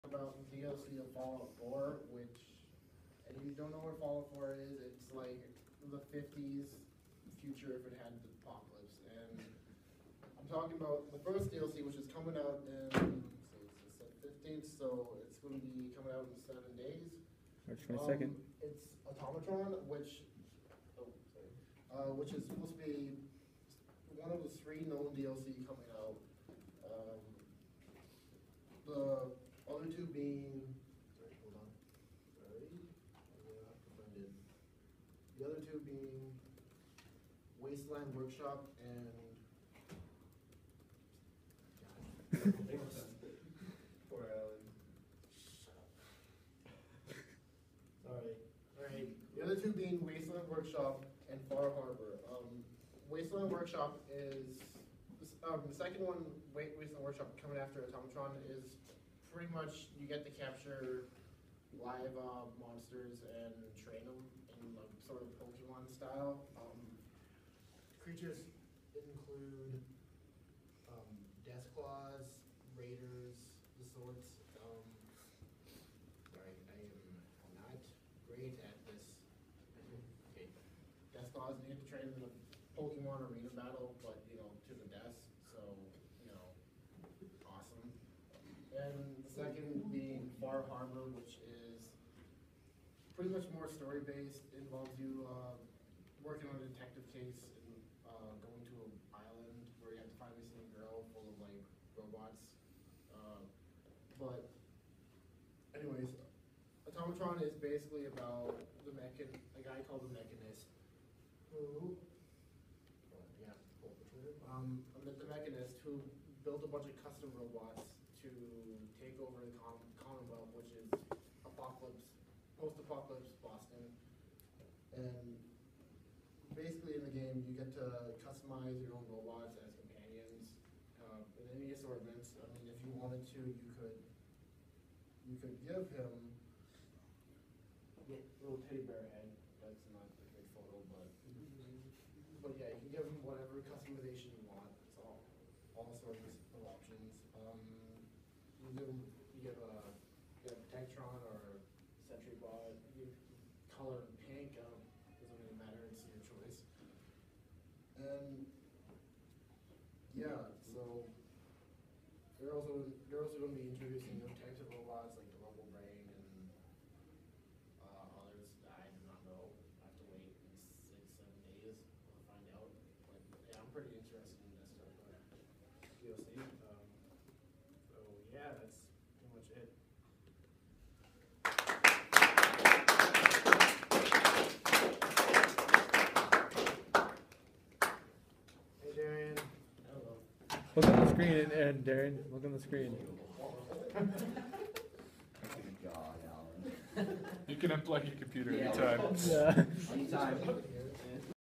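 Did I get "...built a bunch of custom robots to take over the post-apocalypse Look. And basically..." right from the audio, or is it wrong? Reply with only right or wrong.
wrong.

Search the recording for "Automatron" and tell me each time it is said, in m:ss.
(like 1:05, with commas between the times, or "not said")
0:19, 0:57, 1:46.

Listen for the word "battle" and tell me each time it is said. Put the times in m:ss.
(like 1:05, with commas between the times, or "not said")
1:23.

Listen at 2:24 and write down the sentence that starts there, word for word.
It's all all sorts of options.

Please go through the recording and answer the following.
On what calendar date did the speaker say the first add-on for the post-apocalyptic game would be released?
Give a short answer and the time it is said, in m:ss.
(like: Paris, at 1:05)
March 22nd, at 0:17.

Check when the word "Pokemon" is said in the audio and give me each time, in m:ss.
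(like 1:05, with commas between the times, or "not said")
1:05, 1:22.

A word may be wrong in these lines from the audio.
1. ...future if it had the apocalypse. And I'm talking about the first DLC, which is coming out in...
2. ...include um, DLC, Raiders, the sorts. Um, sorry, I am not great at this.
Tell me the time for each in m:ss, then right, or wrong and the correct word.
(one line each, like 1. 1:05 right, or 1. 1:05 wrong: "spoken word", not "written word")
1. 0:07 right
2. 1:08 wrong: "Deathclaws", not "DLC".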